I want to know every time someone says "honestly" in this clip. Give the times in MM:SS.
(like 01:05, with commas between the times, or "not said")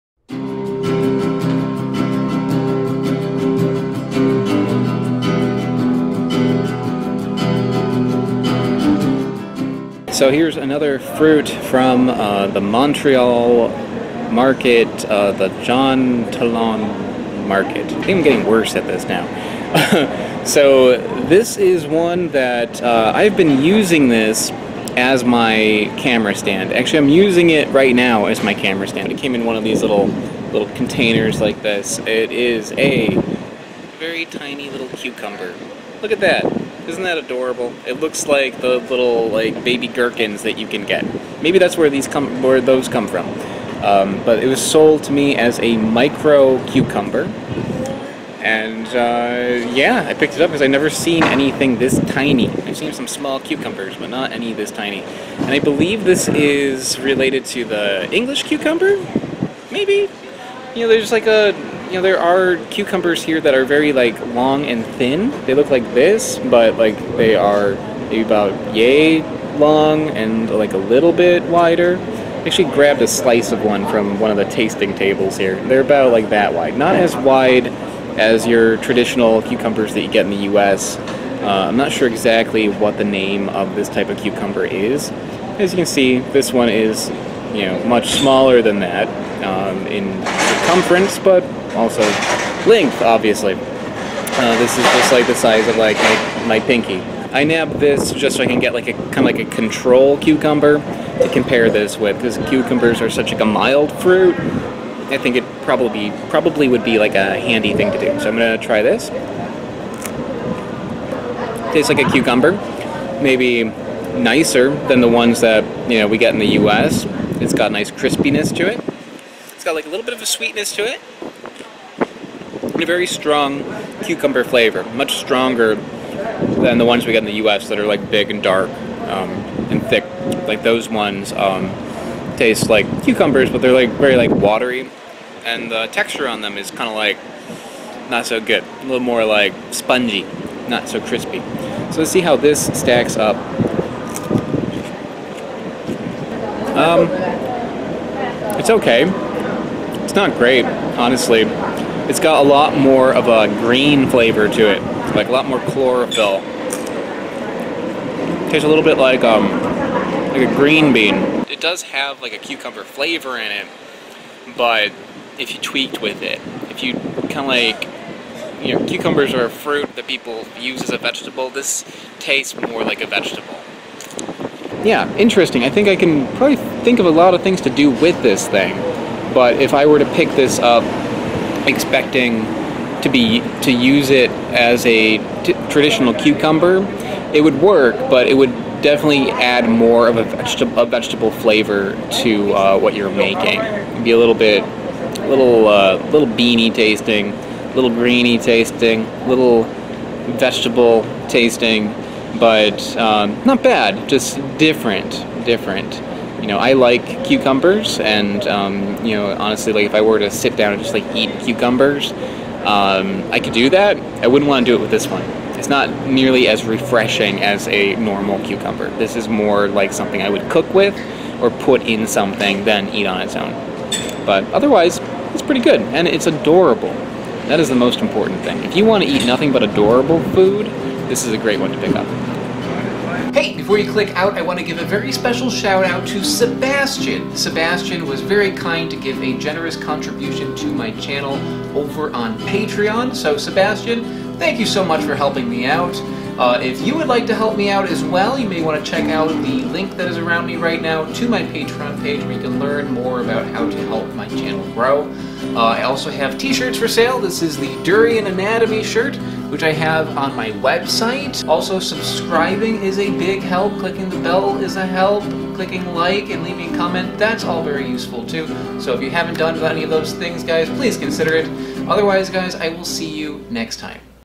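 02:30, 03:29.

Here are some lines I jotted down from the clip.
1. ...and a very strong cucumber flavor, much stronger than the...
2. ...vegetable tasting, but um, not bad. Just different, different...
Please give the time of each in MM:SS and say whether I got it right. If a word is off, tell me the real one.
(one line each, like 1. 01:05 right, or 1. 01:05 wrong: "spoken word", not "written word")
1. 02:02 right
2. 03:20 right.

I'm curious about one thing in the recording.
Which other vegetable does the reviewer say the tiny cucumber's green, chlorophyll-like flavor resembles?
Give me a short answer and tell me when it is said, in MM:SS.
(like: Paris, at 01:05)
green bean, at 02:40.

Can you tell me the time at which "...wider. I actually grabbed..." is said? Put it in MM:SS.
01:11.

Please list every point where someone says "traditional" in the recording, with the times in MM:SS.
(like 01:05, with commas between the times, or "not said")
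01:18, 03:05.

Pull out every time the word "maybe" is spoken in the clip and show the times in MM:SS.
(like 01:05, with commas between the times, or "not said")
00:41, 00:59, 01:08, 01:53.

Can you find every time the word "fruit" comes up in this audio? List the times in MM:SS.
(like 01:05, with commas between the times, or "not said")
00:10, 01:44, 02:49.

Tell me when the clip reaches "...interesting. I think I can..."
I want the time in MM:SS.
02:55.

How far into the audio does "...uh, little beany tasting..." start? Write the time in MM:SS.
03:15.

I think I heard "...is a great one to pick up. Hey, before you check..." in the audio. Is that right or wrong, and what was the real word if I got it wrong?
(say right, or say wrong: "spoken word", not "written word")
wrong: "click", not "check".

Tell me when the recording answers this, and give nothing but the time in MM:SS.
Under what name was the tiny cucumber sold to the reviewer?
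00:45.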